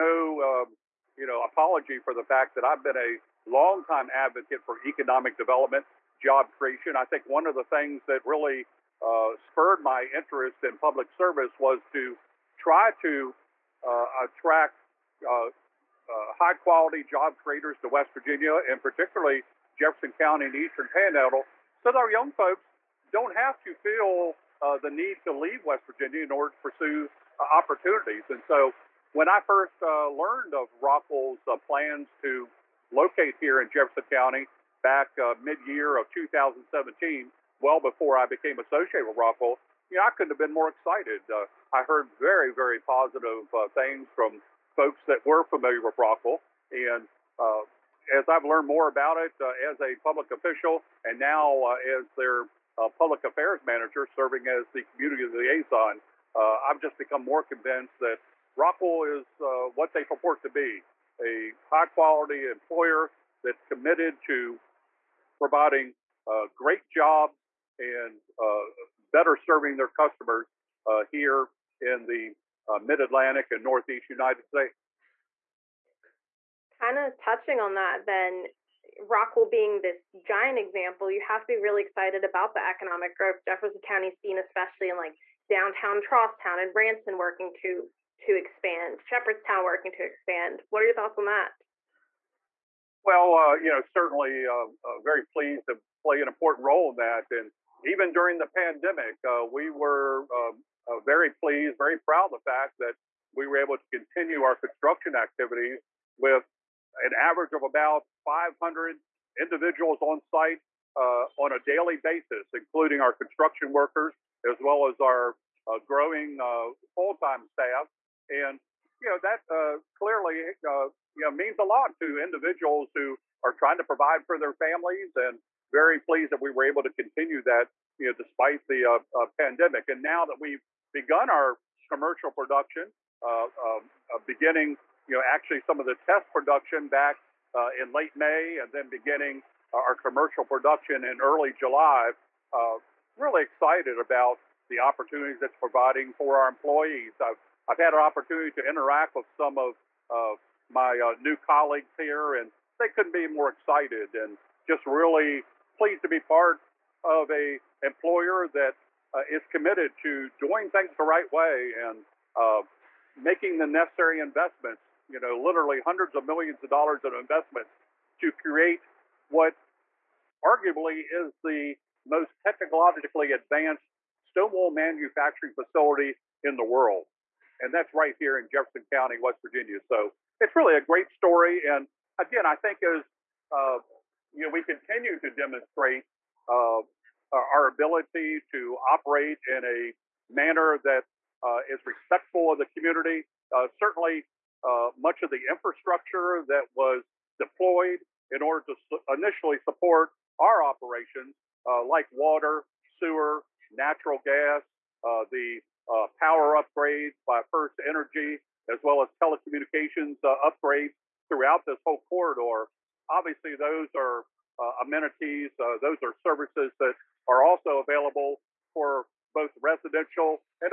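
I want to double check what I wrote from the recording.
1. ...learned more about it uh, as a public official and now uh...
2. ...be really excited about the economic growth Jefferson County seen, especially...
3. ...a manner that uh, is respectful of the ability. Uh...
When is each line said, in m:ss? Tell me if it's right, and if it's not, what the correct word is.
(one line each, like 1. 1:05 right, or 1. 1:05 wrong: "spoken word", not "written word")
1. 0:48 right
2. 1:21 right
3. 3:09 wrong: "community", not "ability".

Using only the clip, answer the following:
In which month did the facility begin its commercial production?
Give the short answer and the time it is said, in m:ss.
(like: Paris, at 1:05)
July, at 2:21.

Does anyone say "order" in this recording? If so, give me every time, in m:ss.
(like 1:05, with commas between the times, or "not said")
0:26, 3:18.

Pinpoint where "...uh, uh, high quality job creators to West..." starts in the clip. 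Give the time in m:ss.
0:15.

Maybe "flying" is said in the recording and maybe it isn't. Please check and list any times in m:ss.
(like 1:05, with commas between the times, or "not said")
not said.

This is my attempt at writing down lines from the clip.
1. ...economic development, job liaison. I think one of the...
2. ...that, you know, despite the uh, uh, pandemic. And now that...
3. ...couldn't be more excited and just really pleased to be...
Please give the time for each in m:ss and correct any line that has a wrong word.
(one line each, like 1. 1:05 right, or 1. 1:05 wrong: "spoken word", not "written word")
1. 0:04 wrong: "creation", not "liaison"
2. 2:07 right
3. 2:32 right.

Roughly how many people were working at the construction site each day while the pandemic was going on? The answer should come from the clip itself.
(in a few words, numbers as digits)
500.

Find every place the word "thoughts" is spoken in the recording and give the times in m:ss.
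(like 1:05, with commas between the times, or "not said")
1:30.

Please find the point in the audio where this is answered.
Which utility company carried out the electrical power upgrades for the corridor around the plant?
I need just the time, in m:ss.
3:27.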